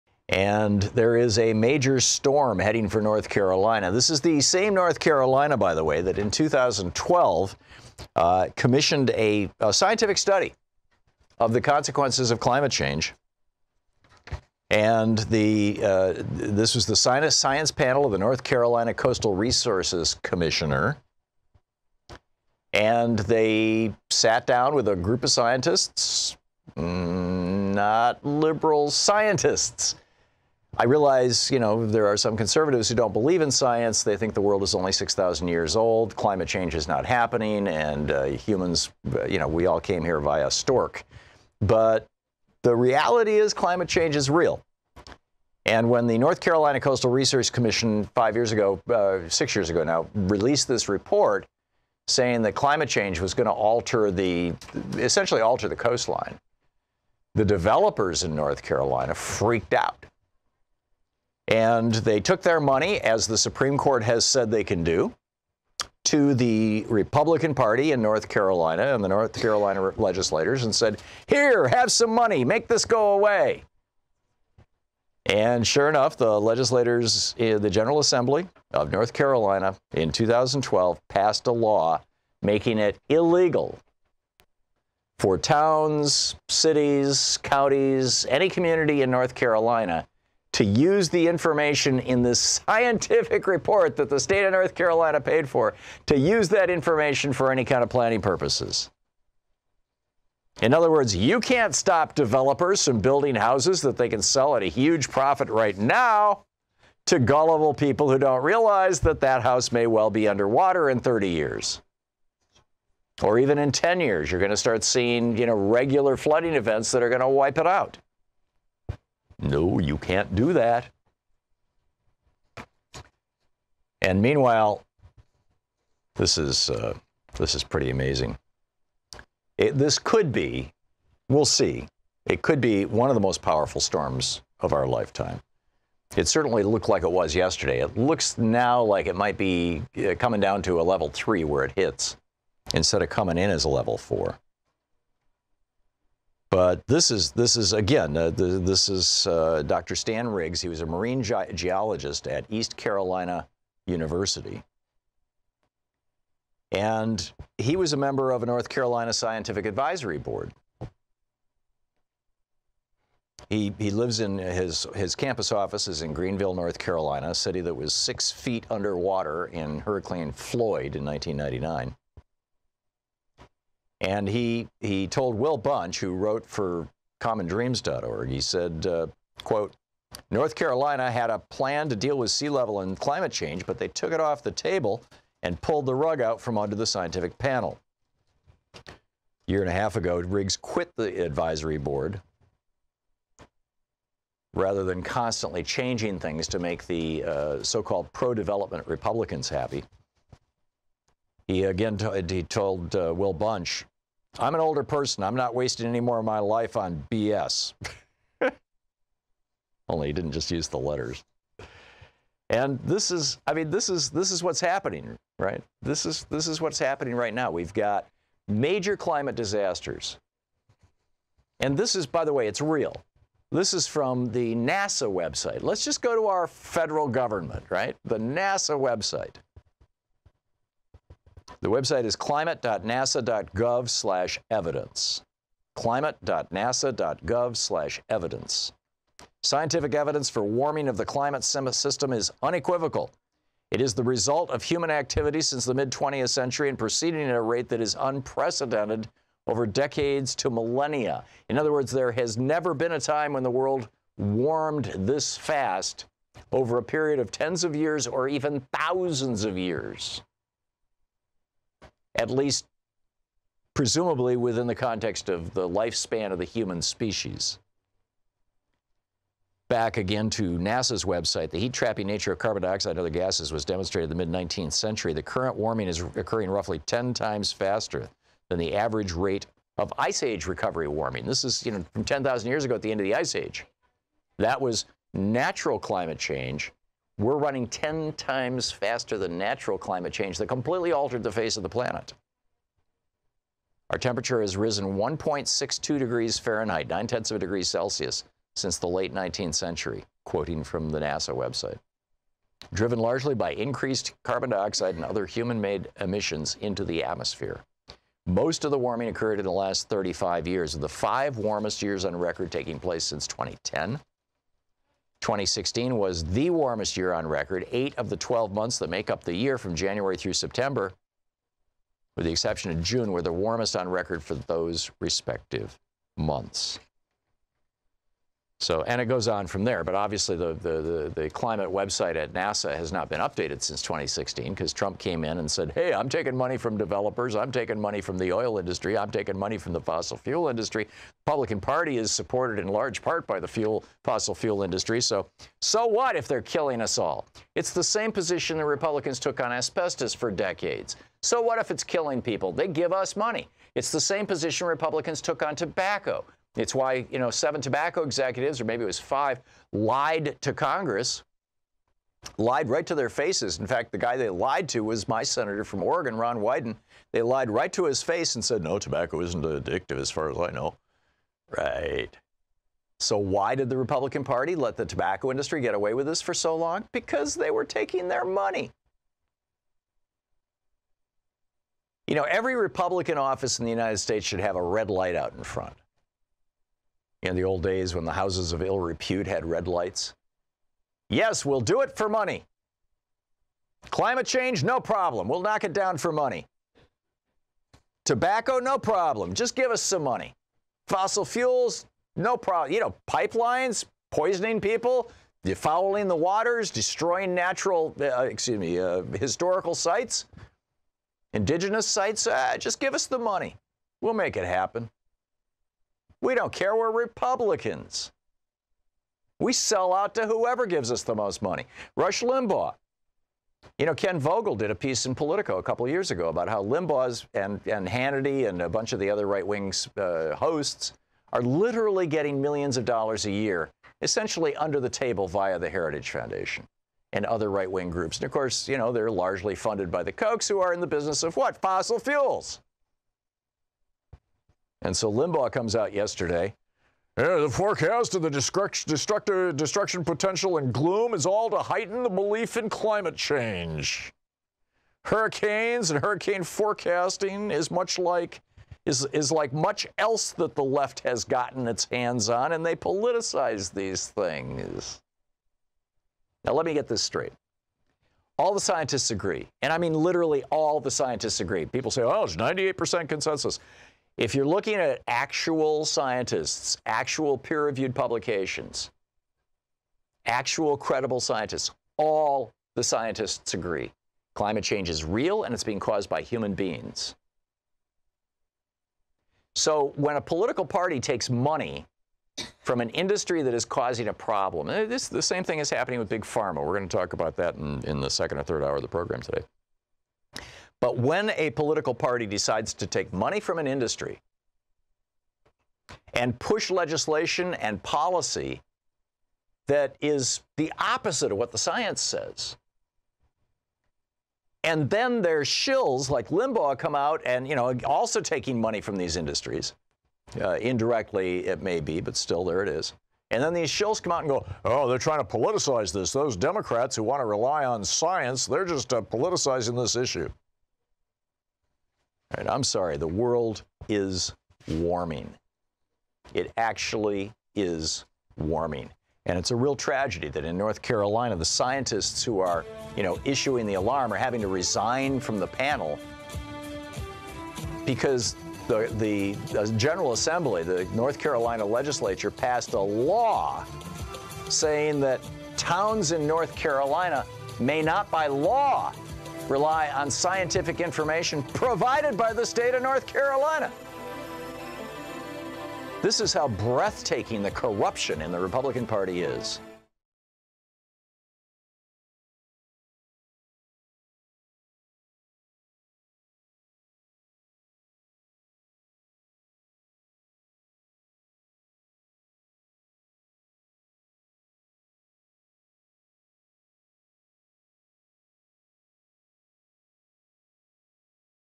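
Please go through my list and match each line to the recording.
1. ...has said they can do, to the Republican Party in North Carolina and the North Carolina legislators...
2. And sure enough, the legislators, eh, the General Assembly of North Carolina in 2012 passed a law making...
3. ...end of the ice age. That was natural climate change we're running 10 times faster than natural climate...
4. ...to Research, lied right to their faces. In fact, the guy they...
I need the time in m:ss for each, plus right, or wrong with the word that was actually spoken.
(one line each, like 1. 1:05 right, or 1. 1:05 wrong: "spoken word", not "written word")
1. 1:04 right
2. 1:15 right
3. 4:42 right
4. 6:00 wrong: "Congress", not "Research".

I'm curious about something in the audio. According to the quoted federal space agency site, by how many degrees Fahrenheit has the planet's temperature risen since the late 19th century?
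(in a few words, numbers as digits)
1.62.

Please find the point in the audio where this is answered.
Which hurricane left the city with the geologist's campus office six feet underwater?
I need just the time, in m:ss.
2:49.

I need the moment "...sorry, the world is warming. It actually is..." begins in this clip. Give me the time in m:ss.
8:52.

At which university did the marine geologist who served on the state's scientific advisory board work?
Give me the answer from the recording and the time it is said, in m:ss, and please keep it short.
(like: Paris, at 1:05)
East Carolina University, at 2:32.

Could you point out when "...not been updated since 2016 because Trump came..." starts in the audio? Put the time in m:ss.
5:32.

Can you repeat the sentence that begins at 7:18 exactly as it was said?
And of course, you know, they're largely funded by the Kochs, who are in the business of what?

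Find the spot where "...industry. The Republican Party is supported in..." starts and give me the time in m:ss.
5:40.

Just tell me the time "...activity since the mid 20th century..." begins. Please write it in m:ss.
4:04.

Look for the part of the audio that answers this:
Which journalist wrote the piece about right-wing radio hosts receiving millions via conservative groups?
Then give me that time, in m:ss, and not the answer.
7:03.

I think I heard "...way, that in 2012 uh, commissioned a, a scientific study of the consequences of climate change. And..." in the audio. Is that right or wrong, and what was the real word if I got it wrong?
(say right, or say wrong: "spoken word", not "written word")
right.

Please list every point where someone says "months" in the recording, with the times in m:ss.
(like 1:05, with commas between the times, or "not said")
5:18, 5:26.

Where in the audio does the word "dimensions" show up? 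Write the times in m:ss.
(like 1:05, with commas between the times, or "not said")
not said.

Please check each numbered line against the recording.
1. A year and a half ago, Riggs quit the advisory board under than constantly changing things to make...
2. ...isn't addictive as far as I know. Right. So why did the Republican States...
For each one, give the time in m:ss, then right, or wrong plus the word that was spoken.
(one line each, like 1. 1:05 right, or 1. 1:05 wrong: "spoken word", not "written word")
1. 3:08 wrong: "rather", not "under"
2. 6:09 wrong: "Party", not "States".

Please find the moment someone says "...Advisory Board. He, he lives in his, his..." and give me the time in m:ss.
2:39.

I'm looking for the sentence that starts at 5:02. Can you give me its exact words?
Driven largely by increased carbon dioxide and other human made emissions into the atmosphere.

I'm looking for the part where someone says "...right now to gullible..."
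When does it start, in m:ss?
1:45.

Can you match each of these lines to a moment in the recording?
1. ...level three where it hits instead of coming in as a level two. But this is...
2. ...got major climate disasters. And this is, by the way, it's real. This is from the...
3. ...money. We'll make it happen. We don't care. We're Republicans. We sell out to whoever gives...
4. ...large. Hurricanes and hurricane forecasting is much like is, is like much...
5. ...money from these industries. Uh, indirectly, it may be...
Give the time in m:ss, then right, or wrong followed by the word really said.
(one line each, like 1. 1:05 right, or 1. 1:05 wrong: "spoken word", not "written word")
1. 2:20 wrong: "four", not "two"
2. 3:37 right
3. 6:53 right
4. 7:33 wrong: "change", not "large"
5. 8:38 right.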